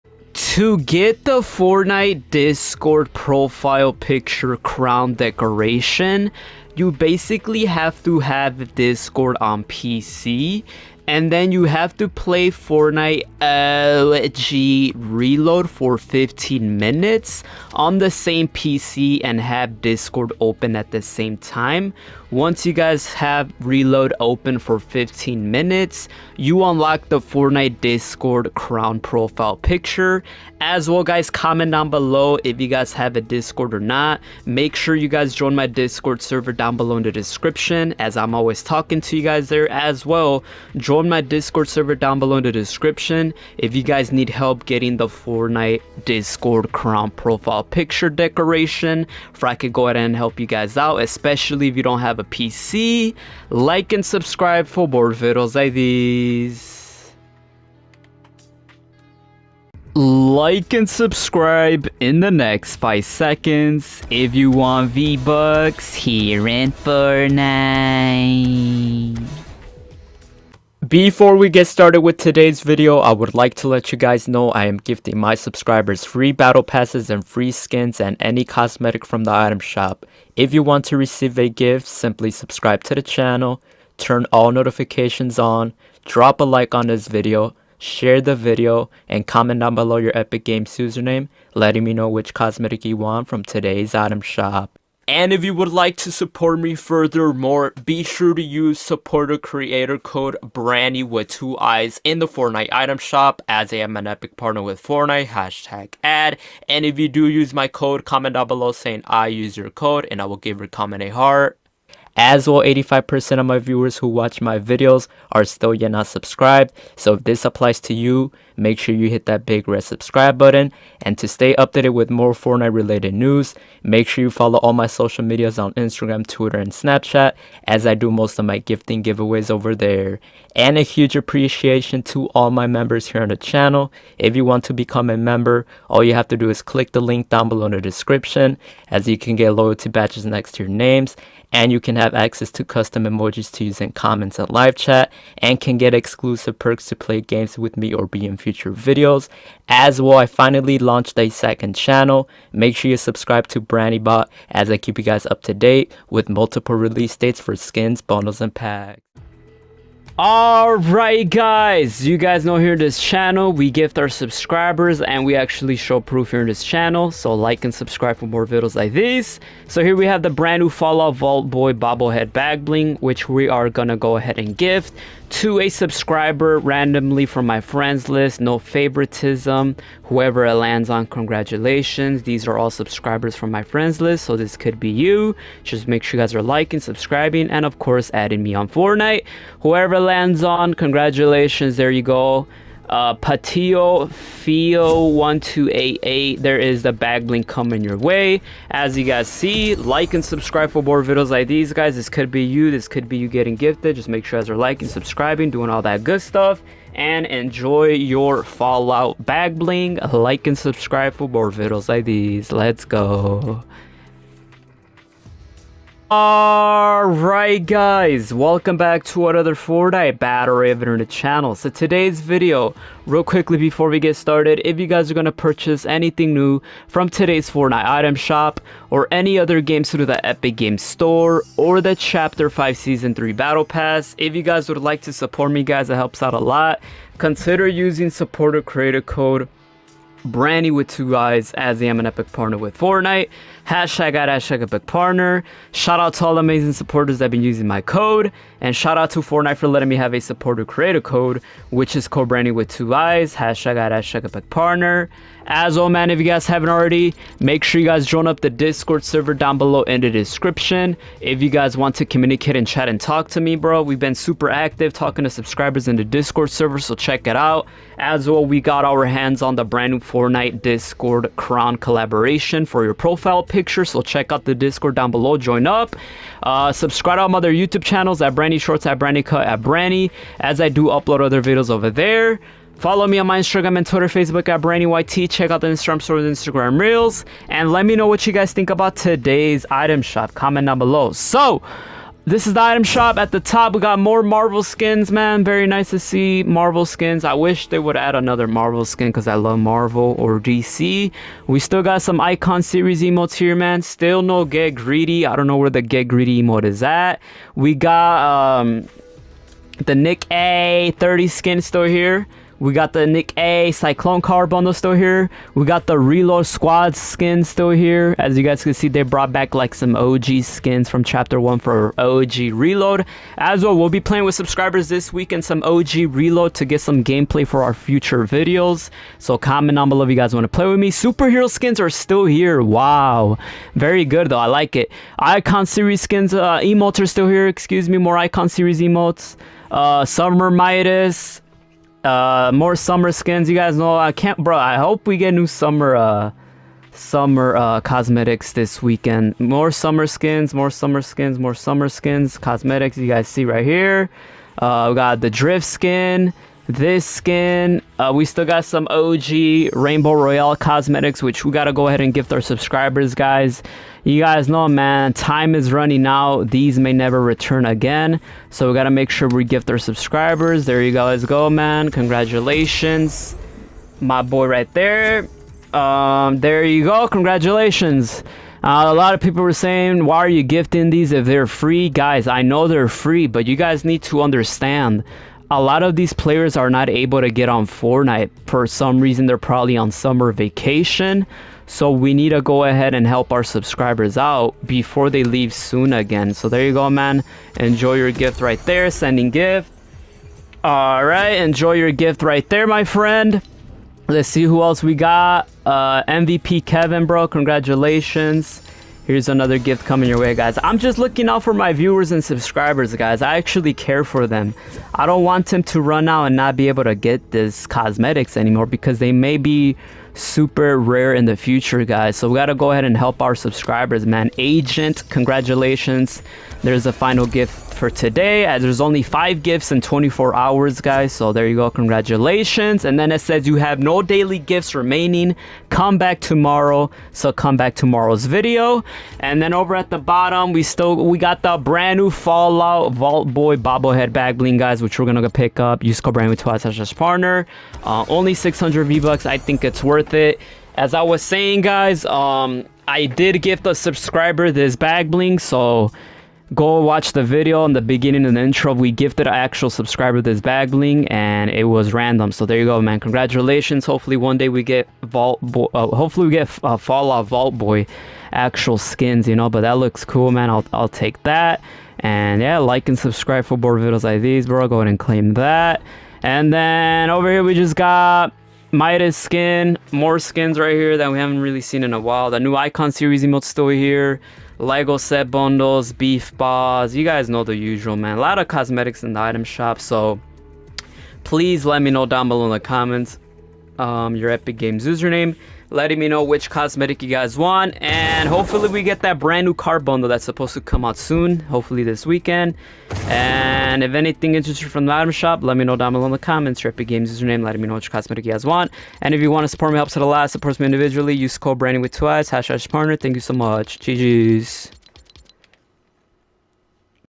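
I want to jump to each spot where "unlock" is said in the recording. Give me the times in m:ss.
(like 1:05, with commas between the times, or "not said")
0:26.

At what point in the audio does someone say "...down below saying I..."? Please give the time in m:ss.
1:48.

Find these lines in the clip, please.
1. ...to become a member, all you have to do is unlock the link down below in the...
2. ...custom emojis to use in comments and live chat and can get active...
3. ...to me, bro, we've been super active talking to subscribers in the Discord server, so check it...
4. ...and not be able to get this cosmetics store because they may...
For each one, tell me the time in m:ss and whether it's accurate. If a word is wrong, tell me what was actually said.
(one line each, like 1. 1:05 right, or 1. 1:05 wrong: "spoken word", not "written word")
1. 2:14 wrong: "click", not "unlock"
2. 2:22 wrong: "exclusive", not "active"
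3. 4:23 right
4. 6:56 wrong: "anymore", not "store".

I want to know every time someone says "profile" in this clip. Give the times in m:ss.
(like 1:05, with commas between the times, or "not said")
0:03, 0:28, 0:47, 4:32.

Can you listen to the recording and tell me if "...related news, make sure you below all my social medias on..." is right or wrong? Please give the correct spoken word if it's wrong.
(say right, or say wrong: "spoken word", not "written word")
wrong: "follow", not "below".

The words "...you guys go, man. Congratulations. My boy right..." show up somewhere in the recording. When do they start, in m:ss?
6:10.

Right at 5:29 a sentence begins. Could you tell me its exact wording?
So comment down below if you guys want to play with me.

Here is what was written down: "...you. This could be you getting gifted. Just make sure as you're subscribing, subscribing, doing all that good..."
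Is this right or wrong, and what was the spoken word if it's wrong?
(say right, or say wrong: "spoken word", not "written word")
wrong: "liking", not "subscribing".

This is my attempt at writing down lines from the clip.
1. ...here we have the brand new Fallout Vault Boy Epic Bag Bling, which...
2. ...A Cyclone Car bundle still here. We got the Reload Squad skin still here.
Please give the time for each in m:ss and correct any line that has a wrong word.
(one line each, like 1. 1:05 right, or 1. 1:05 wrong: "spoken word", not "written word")
1. 2:49 wrong: "Bobblehead", not "Epic"
2. 5:13 right.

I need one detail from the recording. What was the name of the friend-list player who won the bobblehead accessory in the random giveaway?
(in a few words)
Patio Fio 1288.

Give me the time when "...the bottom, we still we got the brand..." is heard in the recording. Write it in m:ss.
7:19.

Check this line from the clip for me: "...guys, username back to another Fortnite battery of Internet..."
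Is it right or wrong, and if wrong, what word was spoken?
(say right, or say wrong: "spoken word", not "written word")
wrong: "welcome", not "username".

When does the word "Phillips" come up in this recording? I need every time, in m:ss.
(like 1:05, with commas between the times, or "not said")
not said.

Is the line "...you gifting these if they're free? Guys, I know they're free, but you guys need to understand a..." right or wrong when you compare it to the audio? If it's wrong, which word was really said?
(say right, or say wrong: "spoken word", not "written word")
right.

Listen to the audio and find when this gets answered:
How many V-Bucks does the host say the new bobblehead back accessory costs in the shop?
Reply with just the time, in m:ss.
7:28.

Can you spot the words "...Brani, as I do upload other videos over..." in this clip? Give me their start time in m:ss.
4:39.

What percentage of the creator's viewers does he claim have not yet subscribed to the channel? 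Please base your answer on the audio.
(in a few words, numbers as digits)
85%.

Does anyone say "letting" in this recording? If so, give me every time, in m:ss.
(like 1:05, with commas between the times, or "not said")
1:31, 4:09, 8:15, 8:27.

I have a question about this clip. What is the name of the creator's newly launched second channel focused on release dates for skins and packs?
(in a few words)
BraniBot.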